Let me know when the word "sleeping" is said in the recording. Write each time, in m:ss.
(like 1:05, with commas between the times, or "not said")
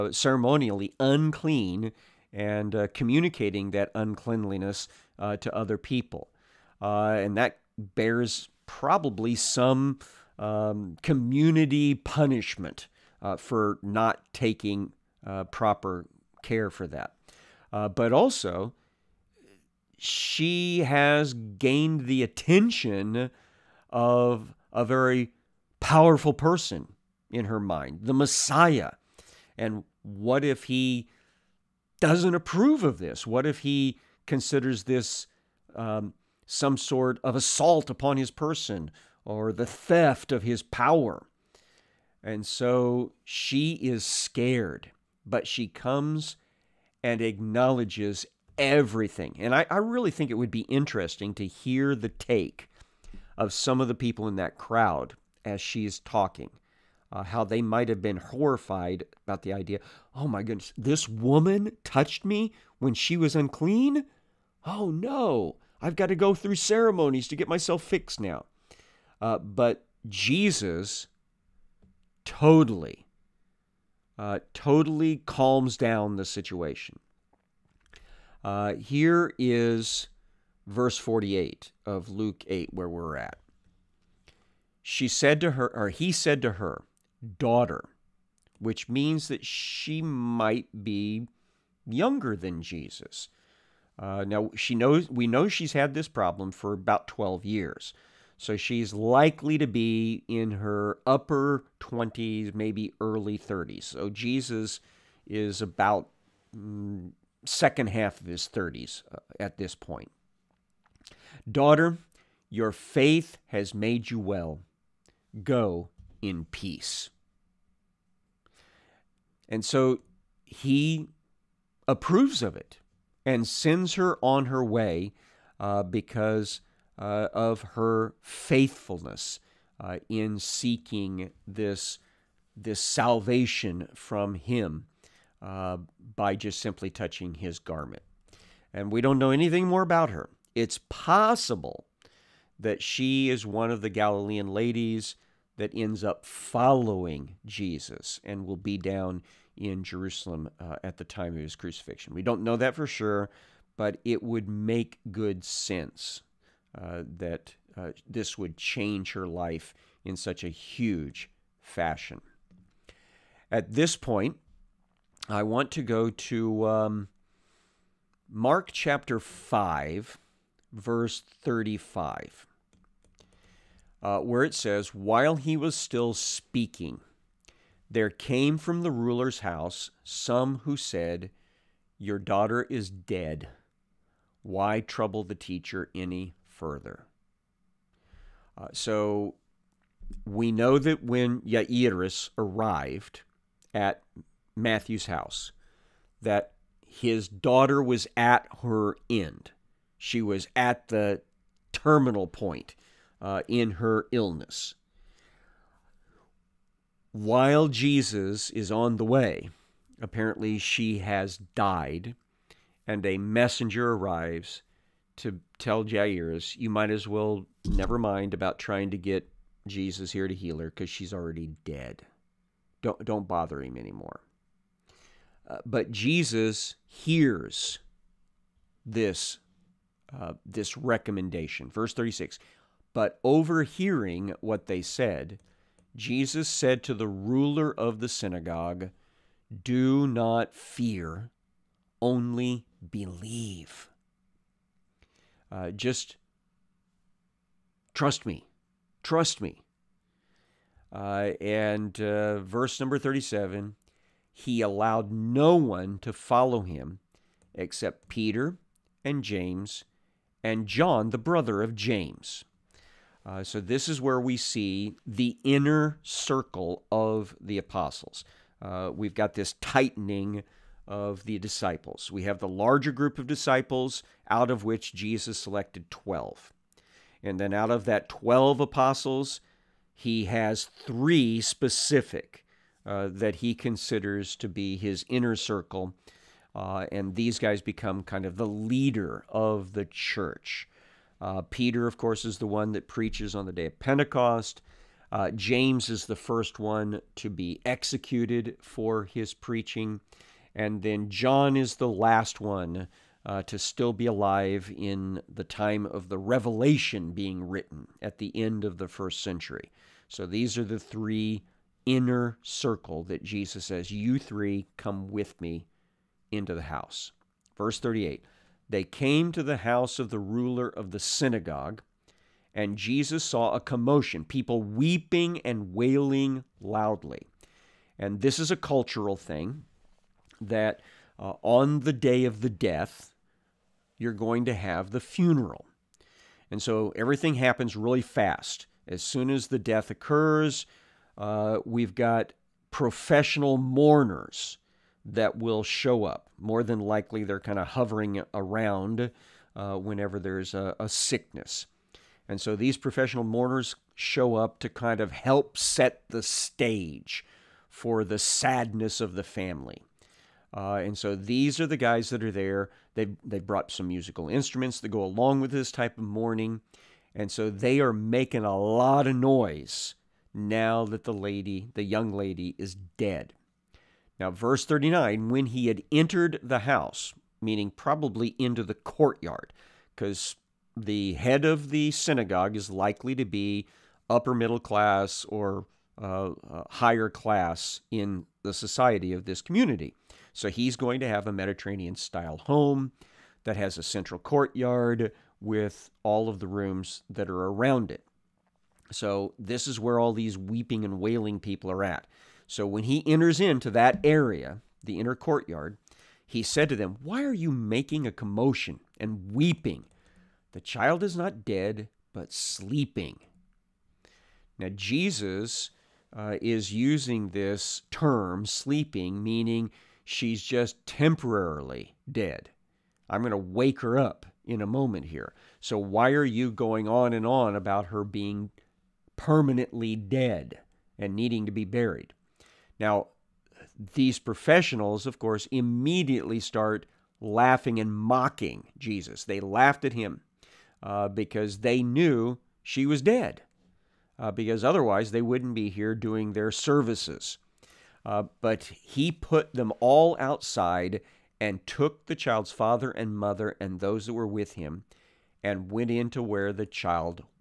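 6:52, 6:58.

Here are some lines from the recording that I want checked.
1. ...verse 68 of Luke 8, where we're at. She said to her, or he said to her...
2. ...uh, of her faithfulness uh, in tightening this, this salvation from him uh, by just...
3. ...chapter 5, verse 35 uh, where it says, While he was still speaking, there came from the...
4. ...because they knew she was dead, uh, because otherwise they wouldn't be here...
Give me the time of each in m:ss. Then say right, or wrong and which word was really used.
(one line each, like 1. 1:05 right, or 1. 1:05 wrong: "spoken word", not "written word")
1. 1:20 wrong: "48", not "68"
2. 2:06 wrong: "seeking", not "tightening"
3. 2:48 right
4. 7:21 right.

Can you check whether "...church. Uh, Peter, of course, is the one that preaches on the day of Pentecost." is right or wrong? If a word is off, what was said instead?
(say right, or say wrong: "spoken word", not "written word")
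right.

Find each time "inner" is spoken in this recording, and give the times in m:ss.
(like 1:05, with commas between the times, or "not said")
4:25, 4:45, 5:11, 6:44.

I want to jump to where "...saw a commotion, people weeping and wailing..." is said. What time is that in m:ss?
5:23.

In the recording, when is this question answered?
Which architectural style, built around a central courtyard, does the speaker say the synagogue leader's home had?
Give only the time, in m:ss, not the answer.
6:31.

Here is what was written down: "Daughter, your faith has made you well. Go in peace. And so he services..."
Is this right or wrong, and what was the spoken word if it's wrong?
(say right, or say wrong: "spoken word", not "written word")
wrong: "approves", not "services".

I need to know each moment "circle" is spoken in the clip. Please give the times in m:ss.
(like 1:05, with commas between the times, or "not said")
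4:26, 4:45, 5:12.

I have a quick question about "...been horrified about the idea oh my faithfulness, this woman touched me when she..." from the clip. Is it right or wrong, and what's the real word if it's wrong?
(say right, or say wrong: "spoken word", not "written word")
wrong: "goodness", not "faithfulness".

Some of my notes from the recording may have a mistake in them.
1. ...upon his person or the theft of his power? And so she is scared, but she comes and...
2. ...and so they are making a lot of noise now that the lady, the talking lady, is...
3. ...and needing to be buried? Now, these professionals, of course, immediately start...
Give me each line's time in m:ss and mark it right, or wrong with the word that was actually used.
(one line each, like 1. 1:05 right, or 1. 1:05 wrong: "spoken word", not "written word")
1. 0:37 right
2. 6:07 wrong: "young", not "talking"
3. 7:10 right.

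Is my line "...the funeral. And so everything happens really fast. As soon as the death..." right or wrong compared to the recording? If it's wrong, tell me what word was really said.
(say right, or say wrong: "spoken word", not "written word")
right.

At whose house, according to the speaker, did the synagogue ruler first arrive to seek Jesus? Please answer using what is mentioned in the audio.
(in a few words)
Matthew's house.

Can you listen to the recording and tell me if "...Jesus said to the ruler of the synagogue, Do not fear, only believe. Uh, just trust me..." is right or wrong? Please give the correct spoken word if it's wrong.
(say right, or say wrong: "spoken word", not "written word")
right.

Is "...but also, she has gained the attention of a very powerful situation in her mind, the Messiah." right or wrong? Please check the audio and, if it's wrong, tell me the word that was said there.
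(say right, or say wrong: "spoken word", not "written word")
wrong: "person", not "situation".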